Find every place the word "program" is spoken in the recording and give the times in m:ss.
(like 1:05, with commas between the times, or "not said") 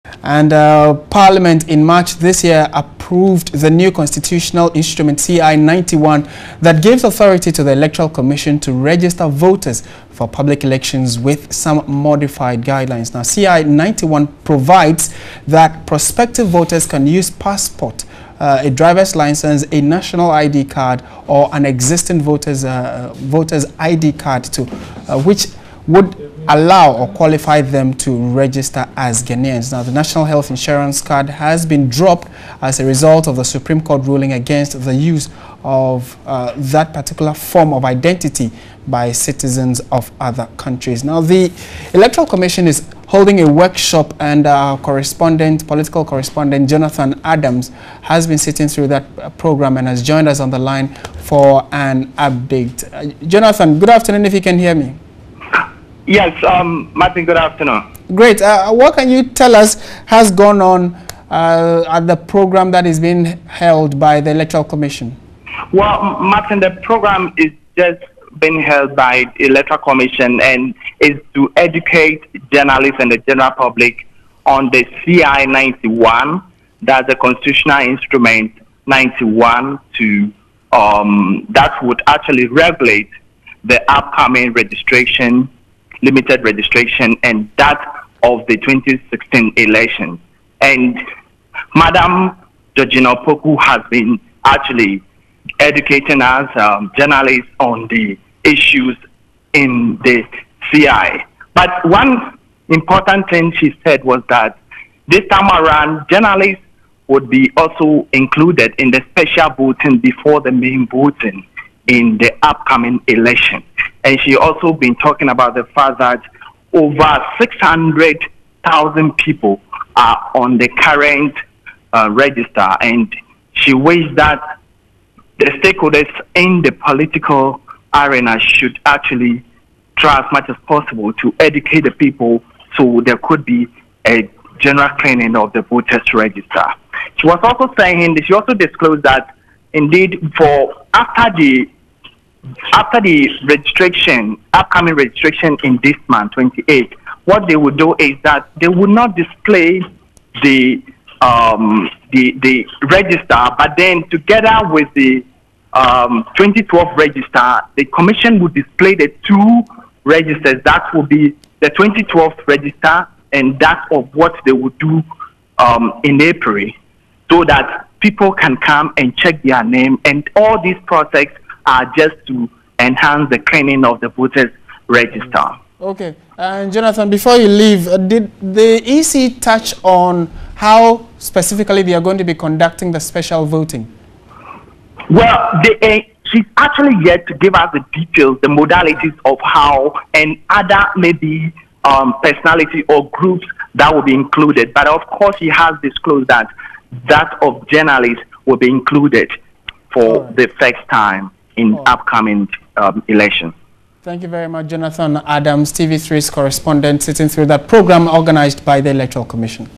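0:49, 1:02, 1:06, 3:27.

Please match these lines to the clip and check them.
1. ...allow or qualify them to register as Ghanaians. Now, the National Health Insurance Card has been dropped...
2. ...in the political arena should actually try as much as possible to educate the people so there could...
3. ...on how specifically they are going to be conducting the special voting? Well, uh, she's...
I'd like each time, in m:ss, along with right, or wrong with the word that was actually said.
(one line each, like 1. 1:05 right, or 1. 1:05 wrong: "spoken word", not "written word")
1. 0:26 right
2. 2:06 right
3. 2:59 right.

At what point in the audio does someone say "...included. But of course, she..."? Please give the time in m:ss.
3:14.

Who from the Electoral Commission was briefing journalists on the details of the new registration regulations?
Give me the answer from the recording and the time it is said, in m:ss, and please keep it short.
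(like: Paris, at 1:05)
Georgina Opoku, at 1:32.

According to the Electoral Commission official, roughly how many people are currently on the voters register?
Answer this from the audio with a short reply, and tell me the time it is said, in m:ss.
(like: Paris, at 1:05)
600,000, at 1:57.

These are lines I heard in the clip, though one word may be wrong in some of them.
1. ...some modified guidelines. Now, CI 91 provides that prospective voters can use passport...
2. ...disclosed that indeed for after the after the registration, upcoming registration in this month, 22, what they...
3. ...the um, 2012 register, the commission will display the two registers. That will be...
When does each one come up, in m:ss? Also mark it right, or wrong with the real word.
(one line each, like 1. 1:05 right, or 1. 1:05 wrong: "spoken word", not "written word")
1. 0:11 right
2. 2:18 wrong: "28", not "22"
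3. 2:34 right.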